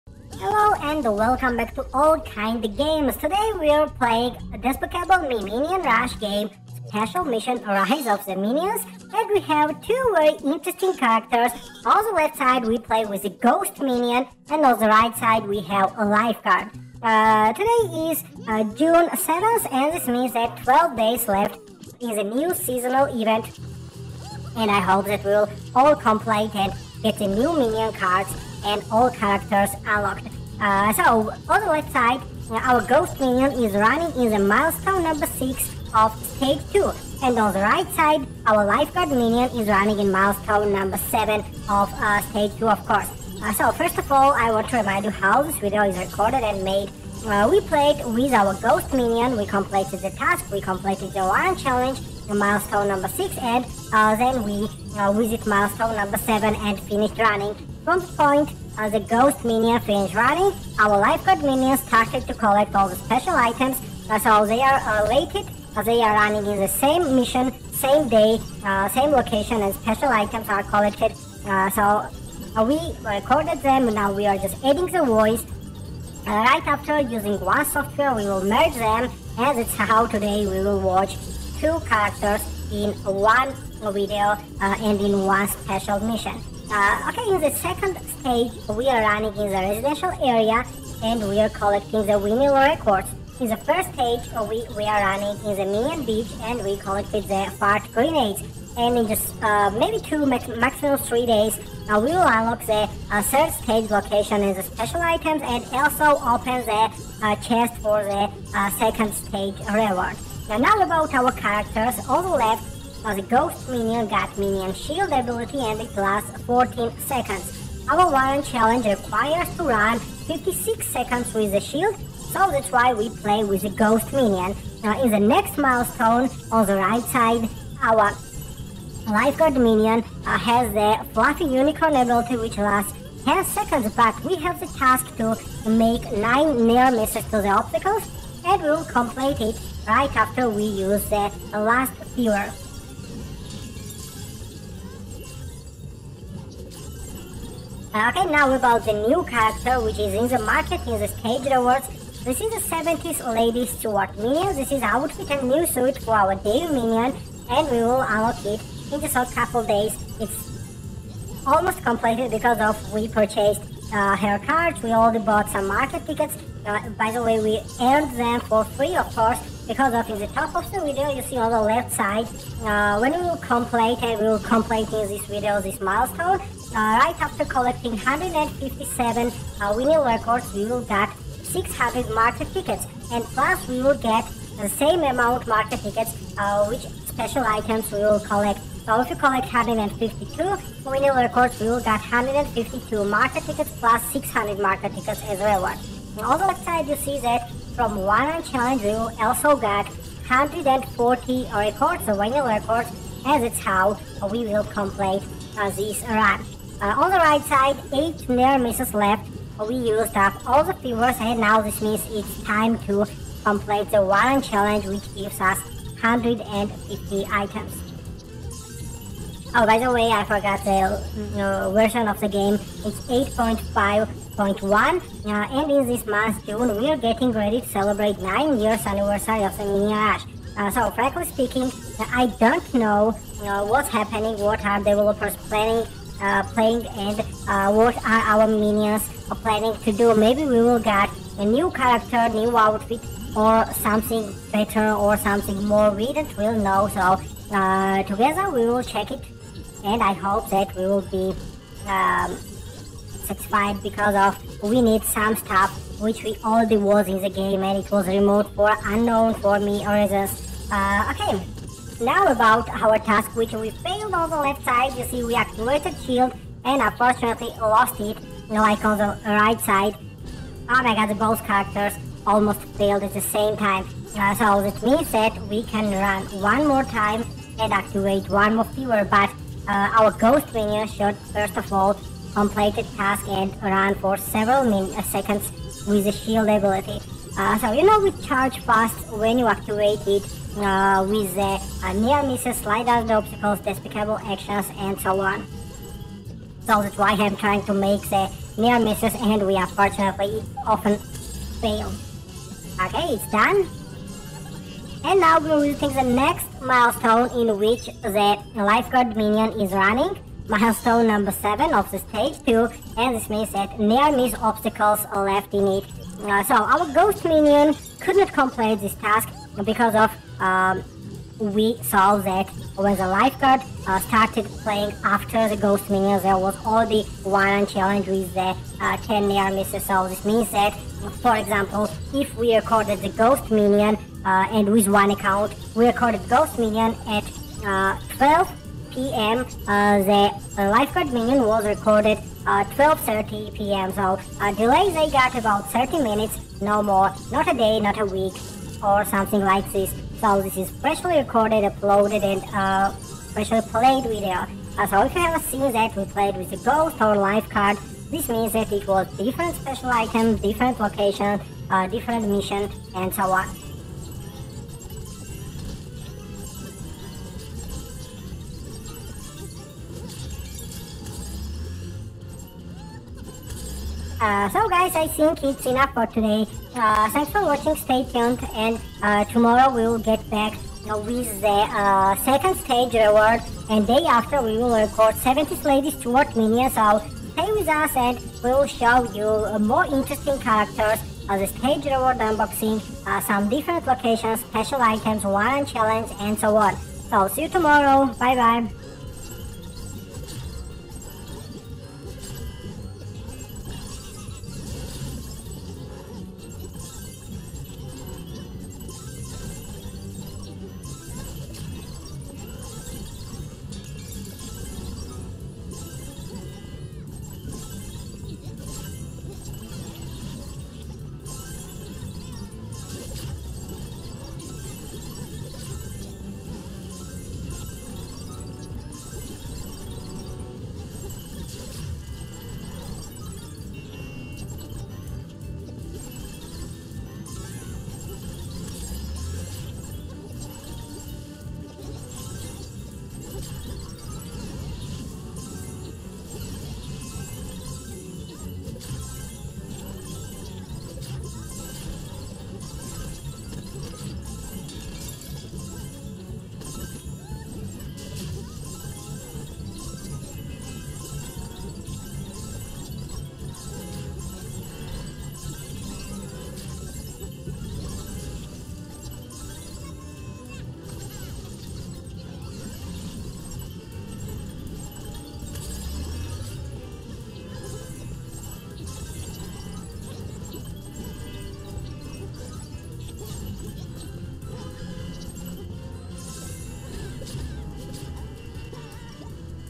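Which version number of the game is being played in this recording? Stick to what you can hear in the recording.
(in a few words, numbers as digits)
8.5.1.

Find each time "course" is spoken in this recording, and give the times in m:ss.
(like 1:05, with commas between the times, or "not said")
0:42, 2:49.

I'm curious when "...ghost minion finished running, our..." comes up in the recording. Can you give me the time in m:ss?
0:58.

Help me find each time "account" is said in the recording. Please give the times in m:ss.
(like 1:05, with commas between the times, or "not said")
5:35.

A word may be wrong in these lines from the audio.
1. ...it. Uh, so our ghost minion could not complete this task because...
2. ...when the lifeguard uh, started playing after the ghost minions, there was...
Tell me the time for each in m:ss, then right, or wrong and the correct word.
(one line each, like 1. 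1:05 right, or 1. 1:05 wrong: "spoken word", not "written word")
1. 5:15 right
2. 5:22 right.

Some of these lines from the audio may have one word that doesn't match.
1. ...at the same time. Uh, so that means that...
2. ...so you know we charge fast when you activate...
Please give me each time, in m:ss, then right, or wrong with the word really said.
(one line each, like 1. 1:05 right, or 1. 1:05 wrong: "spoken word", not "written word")
1. 4:33 right
2. 4:47 right.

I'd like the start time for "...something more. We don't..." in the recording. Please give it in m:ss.
4:05.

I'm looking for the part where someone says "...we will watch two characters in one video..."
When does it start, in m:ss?
1:20.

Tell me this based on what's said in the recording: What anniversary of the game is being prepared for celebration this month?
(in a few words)
9 years.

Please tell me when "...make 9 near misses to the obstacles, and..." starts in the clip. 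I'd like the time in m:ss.
2:15.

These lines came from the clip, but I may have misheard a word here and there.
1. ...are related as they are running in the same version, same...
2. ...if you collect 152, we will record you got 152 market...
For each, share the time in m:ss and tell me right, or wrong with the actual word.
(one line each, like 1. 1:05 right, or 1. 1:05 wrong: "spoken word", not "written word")
1. 1:04 wrong: "mission", not "version"
2. 3:08 right.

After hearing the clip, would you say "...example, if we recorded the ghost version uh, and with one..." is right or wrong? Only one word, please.
wrong.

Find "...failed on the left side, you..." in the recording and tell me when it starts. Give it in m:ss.
4:23.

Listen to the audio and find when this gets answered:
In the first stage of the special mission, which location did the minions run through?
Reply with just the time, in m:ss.
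1:35.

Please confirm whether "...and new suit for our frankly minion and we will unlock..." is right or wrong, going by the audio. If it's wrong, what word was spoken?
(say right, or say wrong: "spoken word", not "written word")
wrong: "daily", not "frankly".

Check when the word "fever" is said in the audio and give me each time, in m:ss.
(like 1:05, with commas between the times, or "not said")
2:22, 3:30, 4:38.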